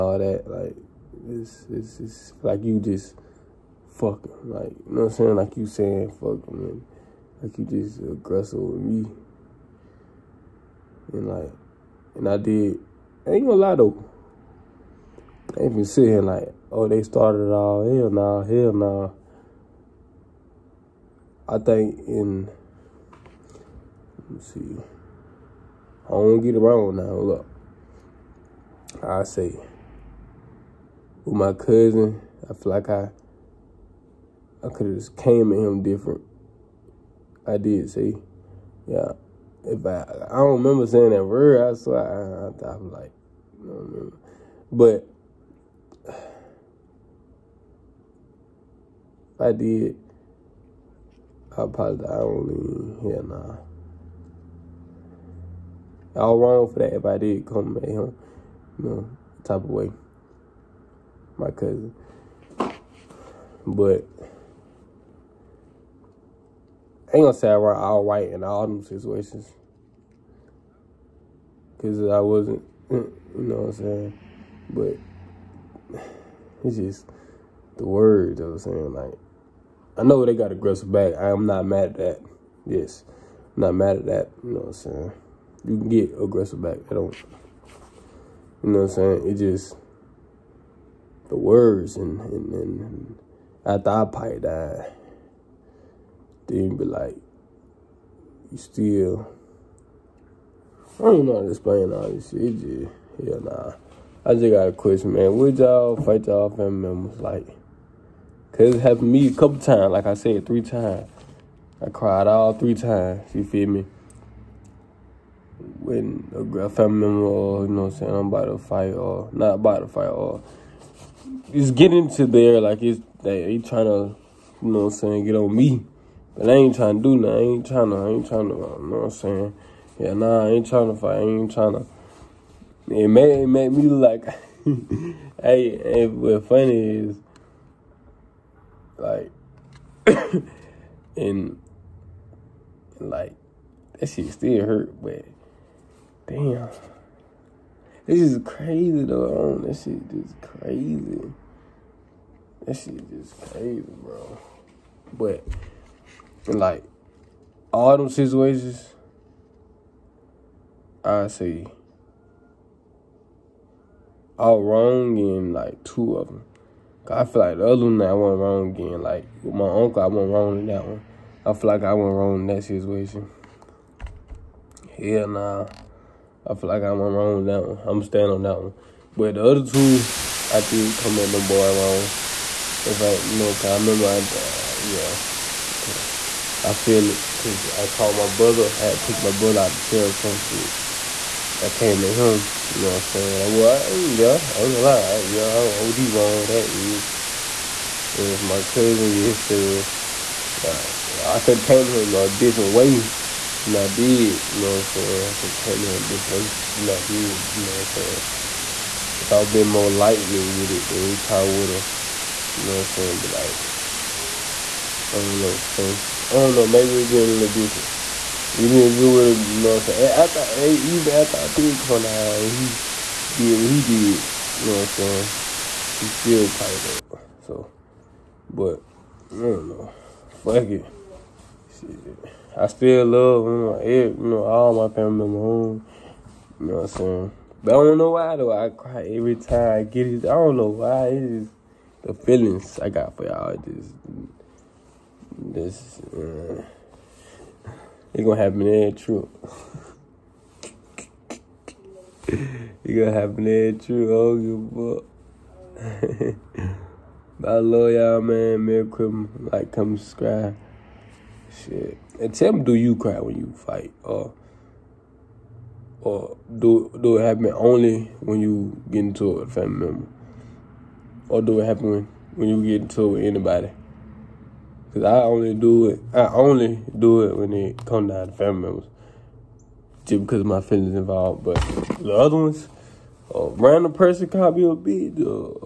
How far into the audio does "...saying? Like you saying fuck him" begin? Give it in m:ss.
0:05.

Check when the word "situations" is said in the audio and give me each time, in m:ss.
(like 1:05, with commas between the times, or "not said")
1:08, 2:38, 2:52.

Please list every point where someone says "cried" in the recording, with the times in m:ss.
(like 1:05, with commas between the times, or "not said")
1:51.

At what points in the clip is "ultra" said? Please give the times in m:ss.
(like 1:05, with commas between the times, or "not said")
not said.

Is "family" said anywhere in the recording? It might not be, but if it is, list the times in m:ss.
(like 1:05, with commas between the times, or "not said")
1:46, 1:56, 3:54, 4:29, 4:38.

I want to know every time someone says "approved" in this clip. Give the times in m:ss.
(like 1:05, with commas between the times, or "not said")
not said.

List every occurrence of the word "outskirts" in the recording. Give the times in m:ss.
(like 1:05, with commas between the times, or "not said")
not said.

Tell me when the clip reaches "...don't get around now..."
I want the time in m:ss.
0:26.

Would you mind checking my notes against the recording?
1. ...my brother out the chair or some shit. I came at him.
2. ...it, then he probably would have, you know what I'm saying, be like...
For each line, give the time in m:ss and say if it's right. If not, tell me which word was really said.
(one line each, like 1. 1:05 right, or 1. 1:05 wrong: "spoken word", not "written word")
1. 3:09 right
2. 3:30 right.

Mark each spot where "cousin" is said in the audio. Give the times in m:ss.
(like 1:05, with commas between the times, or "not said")
0:31, 1:01, 3:18.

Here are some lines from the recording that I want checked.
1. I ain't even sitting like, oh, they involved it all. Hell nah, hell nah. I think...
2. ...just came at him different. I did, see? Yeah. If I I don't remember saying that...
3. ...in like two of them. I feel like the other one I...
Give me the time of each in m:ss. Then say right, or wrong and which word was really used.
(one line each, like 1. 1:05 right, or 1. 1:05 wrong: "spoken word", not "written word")
1. 0:15 wrong: "started", not "involved"
2. 0:34 right
3. 2:45 right.